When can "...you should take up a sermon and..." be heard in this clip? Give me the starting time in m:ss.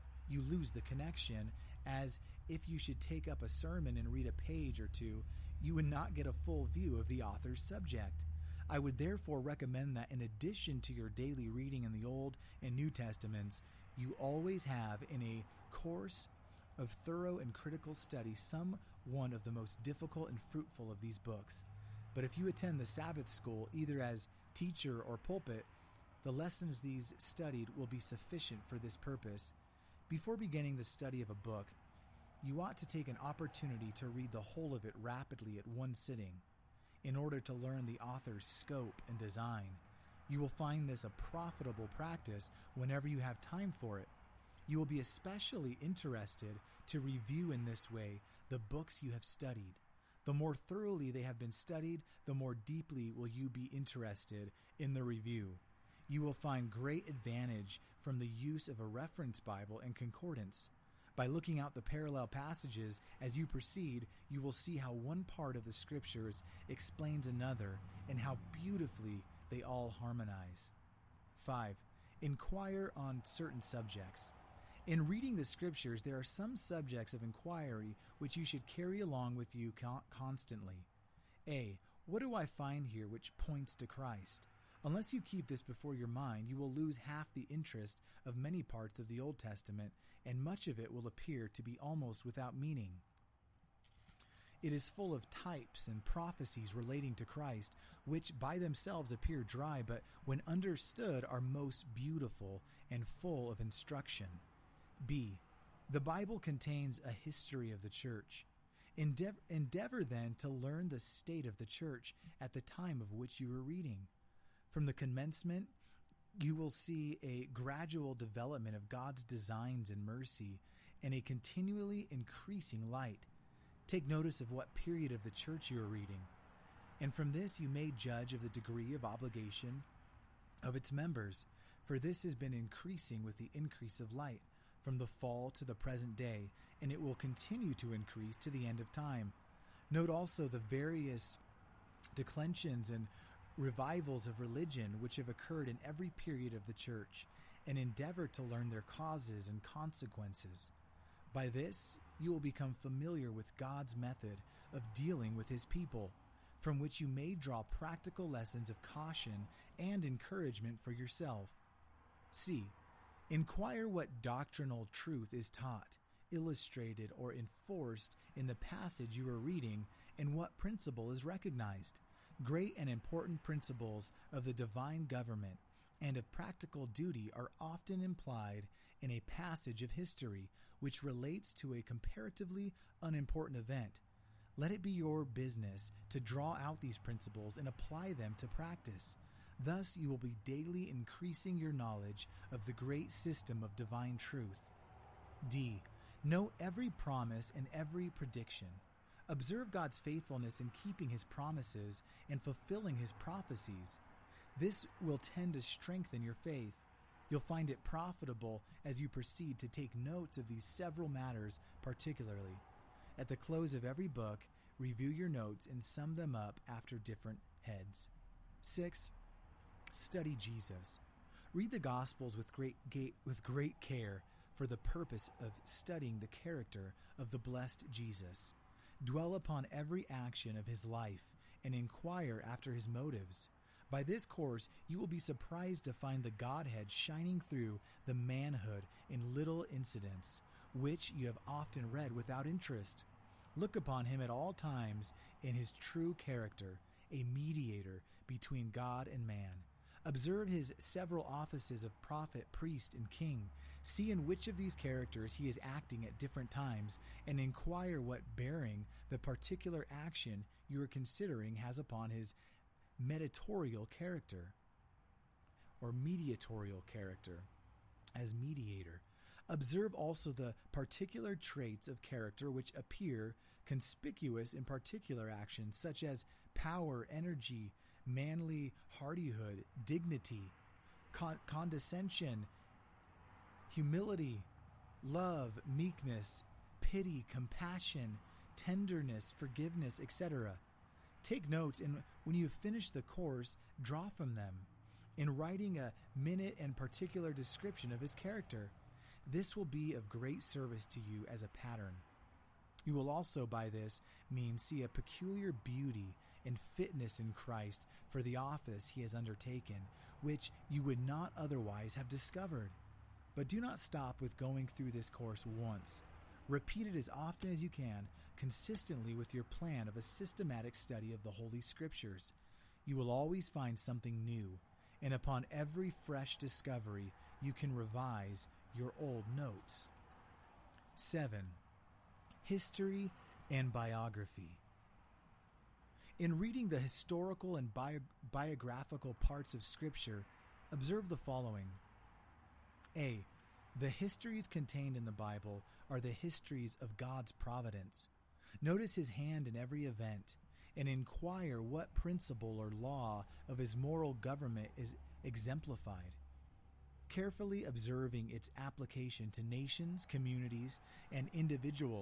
0:02.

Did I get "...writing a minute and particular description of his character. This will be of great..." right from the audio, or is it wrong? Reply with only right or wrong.
right.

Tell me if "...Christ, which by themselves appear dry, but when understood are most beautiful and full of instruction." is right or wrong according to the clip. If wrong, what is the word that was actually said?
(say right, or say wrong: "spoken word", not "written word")
right.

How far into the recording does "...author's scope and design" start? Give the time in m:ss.
0:38.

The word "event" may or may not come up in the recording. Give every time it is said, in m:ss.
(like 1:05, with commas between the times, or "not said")
3:03, 5:49.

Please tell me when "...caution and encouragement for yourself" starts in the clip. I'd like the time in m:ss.
2:38.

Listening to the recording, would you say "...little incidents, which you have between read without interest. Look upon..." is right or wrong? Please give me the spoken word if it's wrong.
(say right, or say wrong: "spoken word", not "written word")
wrong: "often", not "between".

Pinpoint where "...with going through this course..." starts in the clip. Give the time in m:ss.
5:14.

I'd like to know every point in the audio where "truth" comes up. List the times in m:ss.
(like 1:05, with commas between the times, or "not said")
2:44, 3:14.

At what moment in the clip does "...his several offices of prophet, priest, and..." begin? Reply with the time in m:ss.
4:10.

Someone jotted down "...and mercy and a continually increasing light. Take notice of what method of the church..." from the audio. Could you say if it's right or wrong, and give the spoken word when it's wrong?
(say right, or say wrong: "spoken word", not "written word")
wrong: "period", not "method".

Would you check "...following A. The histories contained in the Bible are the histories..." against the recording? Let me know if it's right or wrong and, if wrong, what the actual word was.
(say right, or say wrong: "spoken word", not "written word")
right.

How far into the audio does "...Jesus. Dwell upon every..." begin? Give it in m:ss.
3:47.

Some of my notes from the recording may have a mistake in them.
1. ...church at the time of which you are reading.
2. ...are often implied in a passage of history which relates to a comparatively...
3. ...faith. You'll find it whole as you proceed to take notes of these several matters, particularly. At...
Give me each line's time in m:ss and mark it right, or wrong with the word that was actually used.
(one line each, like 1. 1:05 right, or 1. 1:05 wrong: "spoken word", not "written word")
1. 1:51 right
2. 2:57 right
3. 3:26 wrong: "profitable", not "whole".